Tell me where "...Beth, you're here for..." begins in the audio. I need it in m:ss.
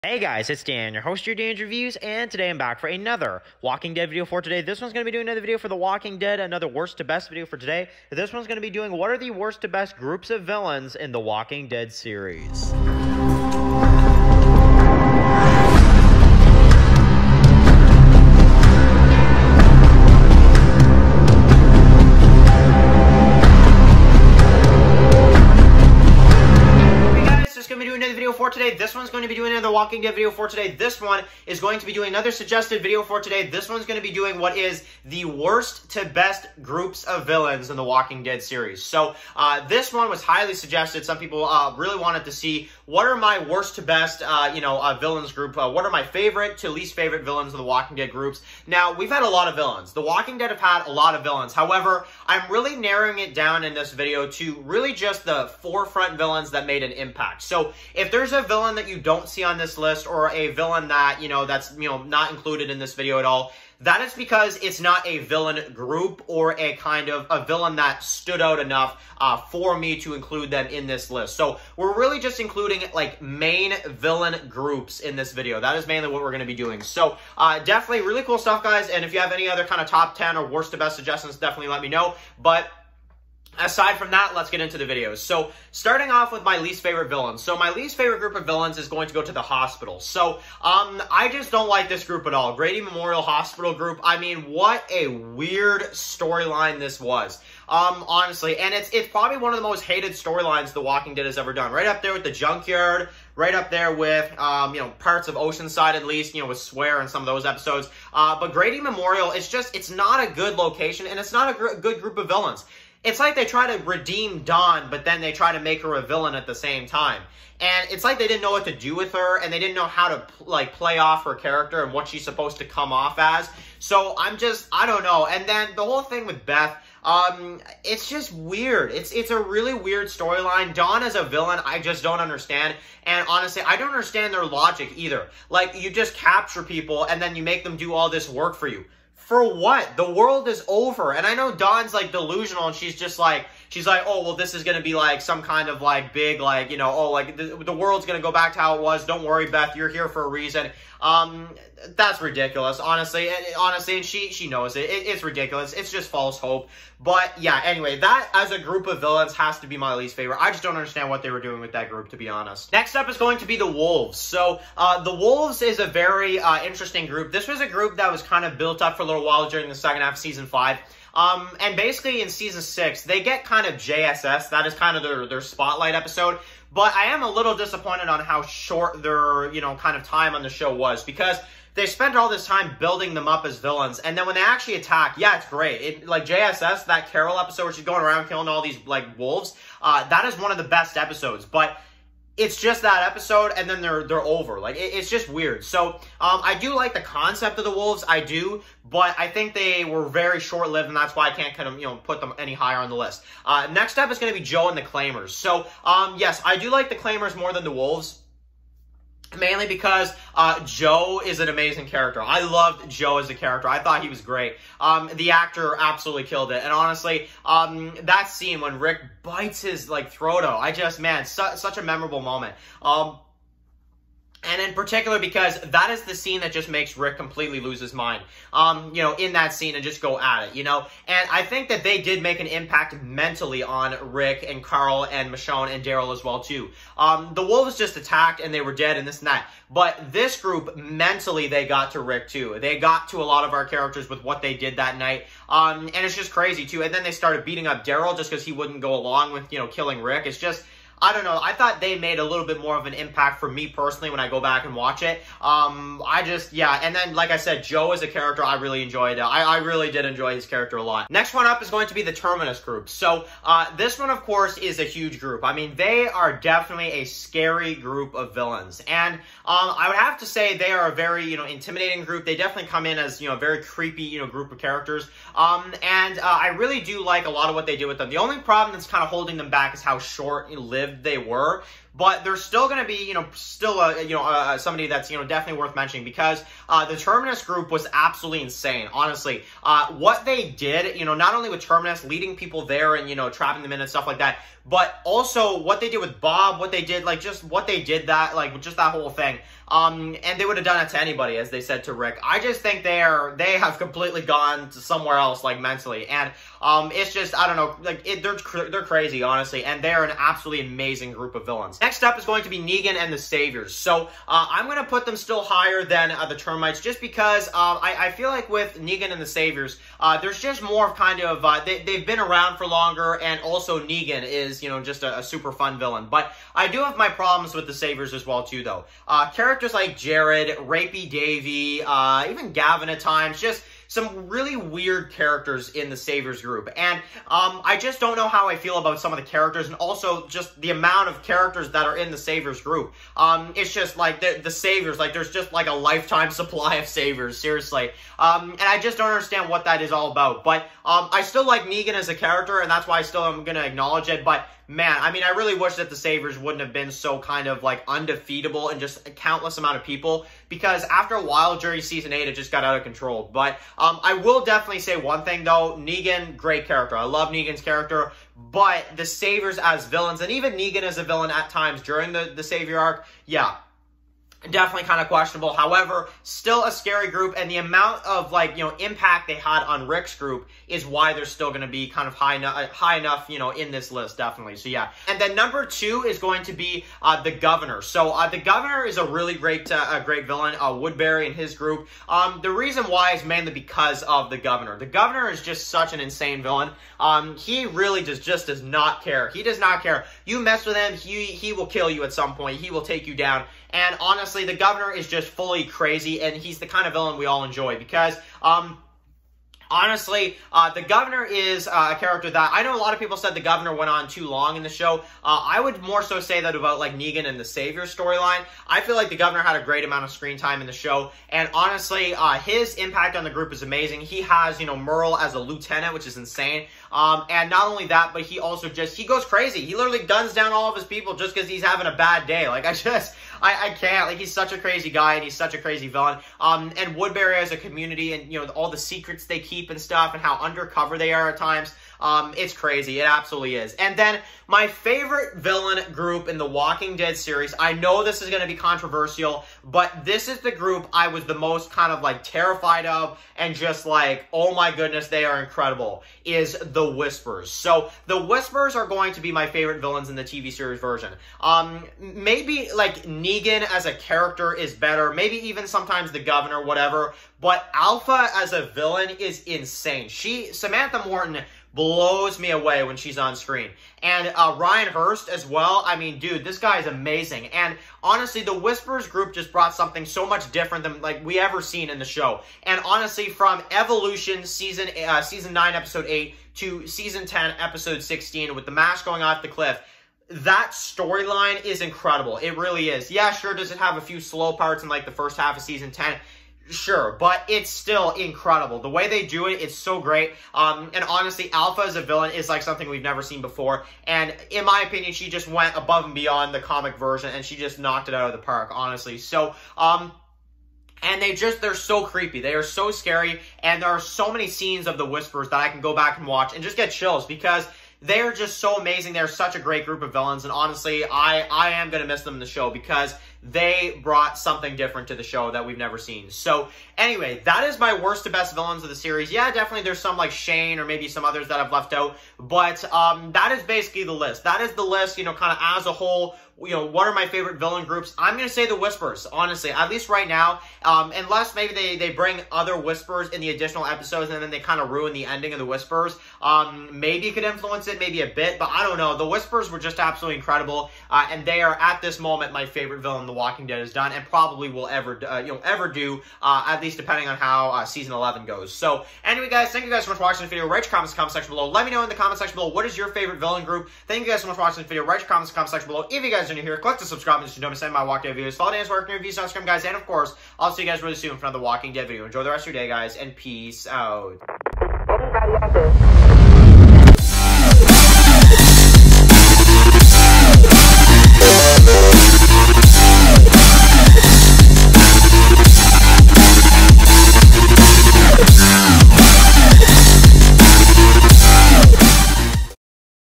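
2:29.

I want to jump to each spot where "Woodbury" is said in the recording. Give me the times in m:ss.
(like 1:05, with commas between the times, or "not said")
6:30, 7:16.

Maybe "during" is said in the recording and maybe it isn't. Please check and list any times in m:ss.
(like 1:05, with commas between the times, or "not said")
2:49, 6:01, 6:11.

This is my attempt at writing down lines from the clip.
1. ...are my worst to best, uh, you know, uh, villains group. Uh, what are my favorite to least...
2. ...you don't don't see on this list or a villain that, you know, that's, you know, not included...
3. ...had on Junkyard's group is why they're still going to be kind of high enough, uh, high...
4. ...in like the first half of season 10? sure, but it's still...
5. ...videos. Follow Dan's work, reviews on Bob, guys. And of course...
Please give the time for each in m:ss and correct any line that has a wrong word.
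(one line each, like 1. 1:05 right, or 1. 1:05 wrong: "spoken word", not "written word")
1. 0:43 right
2. 0:58 right
3. 6:19 wrong: "Rick", not "Junkyard"
4. 8:14 right
5. 9:28 wrong: "Instagram", not "Bob".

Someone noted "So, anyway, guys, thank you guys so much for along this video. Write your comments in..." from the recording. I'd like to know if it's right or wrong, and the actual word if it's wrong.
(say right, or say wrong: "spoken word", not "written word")
wrong: "watching", not "along".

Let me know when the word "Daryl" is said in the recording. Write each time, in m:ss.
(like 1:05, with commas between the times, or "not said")
3:55, 4:07.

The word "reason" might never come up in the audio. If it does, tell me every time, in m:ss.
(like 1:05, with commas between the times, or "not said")
2:30, 6:32.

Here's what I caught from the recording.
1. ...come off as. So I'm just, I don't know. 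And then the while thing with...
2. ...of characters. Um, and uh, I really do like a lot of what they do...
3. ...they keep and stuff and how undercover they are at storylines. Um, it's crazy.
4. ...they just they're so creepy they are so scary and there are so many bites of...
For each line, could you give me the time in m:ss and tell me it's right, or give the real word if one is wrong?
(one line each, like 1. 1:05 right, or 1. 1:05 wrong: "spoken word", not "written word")
1. 2:02 wrong: "whole", not "while"
2. 4:34 right
3. 7:19 wrong: "times", not "storylines"
4. 8:31 wrong: "scenes", not "bites".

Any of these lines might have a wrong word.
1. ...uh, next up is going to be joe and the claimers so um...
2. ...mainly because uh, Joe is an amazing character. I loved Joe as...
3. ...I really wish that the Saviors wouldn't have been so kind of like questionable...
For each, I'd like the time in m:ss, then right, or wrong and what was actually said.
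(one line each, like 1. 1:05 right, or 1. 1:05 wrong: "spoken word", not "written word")
1. 3:23 right
2. 3:29 right
3. 5:55 wrong: "undefeatable", not "questionable".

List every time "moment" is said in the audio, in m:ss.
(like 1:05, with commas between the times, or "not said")
3:42, 9:12.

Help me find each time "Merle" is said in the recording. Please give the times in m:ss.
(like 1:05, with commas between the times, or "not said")
7:04.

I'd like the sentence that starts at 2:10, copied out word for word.
Dawn as a villain, I just don't understand.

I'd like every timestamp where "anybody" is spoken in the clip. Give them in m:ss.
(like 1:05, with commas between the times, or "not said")
5:01.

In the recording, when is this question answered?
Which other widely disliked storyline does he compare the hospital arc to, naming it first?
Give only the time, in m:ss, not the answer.
1:42.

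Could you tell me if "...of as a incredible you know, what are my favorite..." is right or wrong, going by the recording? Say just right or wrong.
wrong.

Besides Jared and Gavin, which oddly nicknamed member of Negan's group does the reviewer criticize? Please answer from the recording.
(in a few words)
Rapey Davey.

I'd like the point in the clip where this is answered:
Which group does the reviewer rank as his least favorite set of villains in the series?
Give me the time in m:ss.
1:32.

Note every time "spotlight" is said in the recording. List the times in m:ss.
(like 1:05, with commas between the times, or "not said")
2:55.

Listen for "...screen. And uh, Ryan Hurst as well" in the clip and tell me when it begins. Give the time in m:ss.
7:53.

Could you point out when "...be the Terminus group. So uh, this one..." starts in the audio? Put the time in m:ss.
4:21.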